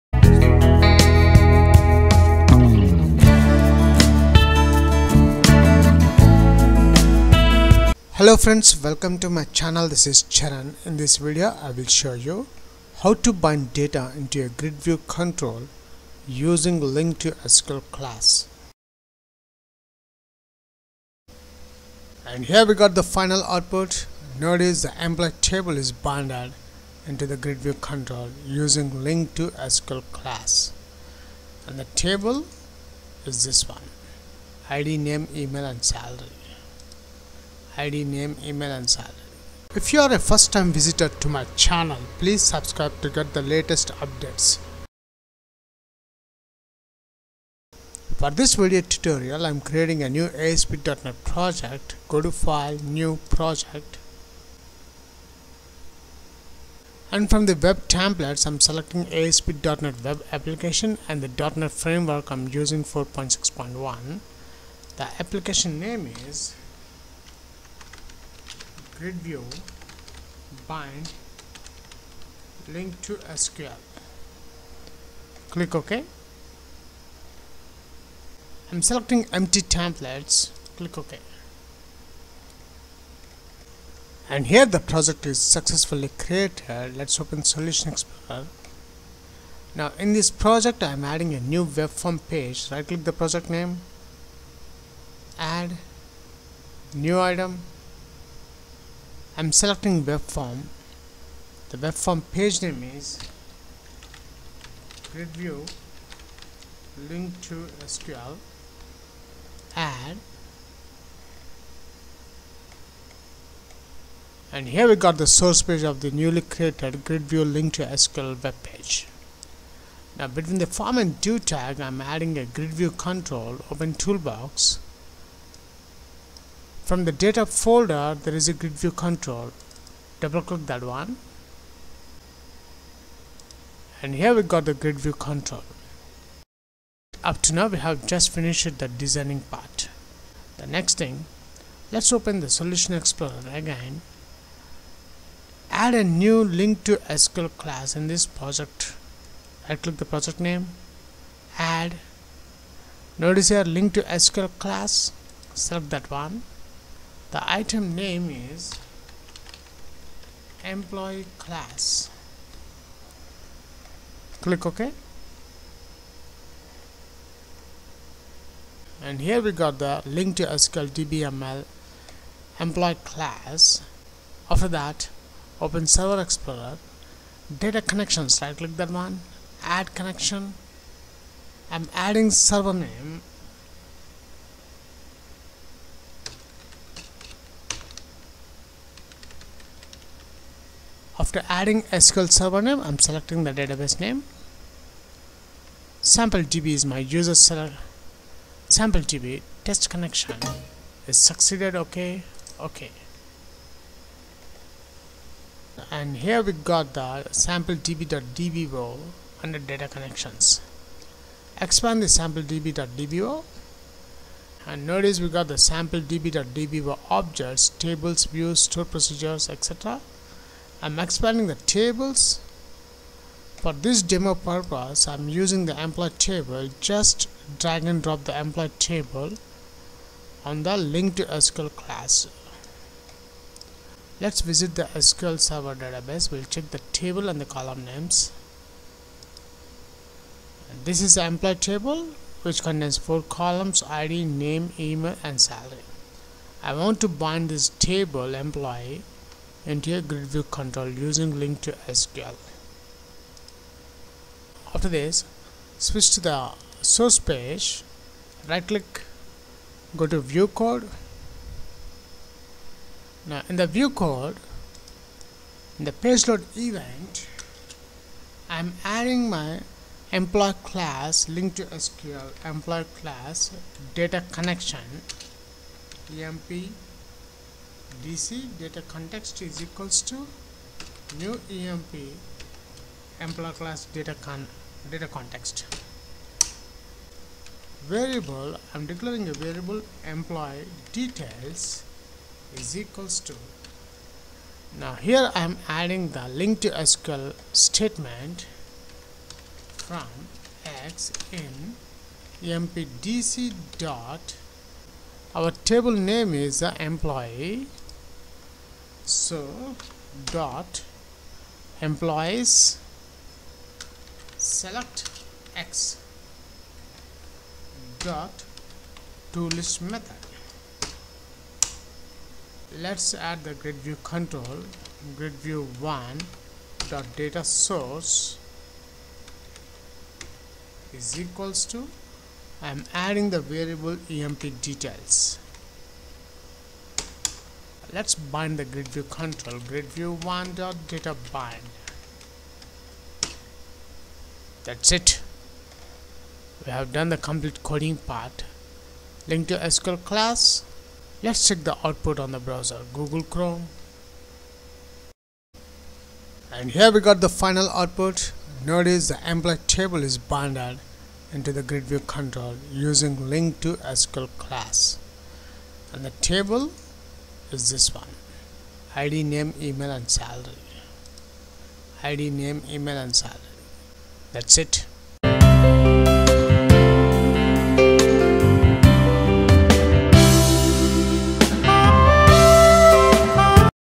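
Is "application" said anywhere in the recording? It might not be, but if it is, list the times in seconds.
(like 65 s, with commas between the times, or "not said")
60 s, 65 s.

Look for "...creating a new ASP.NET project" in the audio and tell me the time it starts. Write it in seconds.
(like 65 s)
49 s.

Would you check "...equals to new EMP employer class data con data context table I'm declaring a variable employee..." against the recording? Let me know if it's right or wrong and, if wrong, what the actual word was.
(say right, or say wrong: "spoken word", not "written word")
wrong: "variable", not "table".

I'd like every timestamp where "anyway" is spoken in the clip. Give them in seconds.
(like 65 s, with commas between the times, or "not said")
not said.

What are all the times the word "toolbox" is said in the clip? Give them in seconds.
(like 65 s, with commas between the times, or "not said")
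123 s.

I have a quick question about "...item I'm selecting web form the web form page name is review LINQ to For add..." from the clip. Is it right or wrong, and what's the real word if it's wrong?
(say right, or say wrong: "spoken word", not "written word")
wrong: "SQL", not "For".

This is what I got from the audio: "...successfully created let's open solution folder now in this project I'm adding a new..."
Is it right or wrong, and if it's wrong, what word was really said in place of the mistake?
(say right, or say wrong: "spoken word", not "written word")
wrong: "explorer", not "folder".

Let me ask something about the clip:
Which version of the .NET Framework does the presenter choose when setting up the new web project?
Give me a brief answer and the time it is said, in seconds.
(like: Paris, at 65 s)
4.6.1, at 62 s.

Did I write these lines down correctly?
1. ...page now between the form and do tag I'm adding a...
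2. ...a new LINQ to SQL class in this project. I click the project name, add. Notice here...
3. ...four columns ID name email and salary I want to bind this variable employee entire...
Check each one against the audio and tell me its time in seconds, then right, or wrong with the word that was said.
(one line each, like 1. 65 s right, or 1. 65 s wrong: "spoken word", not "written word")
1. 118 s right
2. 145 s right
3. 242 s wrong: "table", not "variable".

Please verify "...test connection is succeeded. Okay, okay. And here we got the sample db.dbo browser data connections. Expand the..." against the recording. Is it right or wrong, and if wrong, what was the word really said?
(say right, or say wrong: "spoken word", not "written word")
wrong: "under", not "browser".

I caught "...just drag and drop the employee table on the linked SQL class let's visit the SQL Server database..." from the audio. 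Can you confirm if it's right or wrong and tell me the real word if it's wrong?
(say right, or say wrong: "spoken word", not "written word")
right.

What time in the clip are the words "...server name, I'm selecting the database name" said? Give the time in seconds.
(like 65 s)
192 s.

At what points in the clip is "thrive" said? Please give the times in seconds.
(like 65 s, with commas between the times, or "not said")
not said.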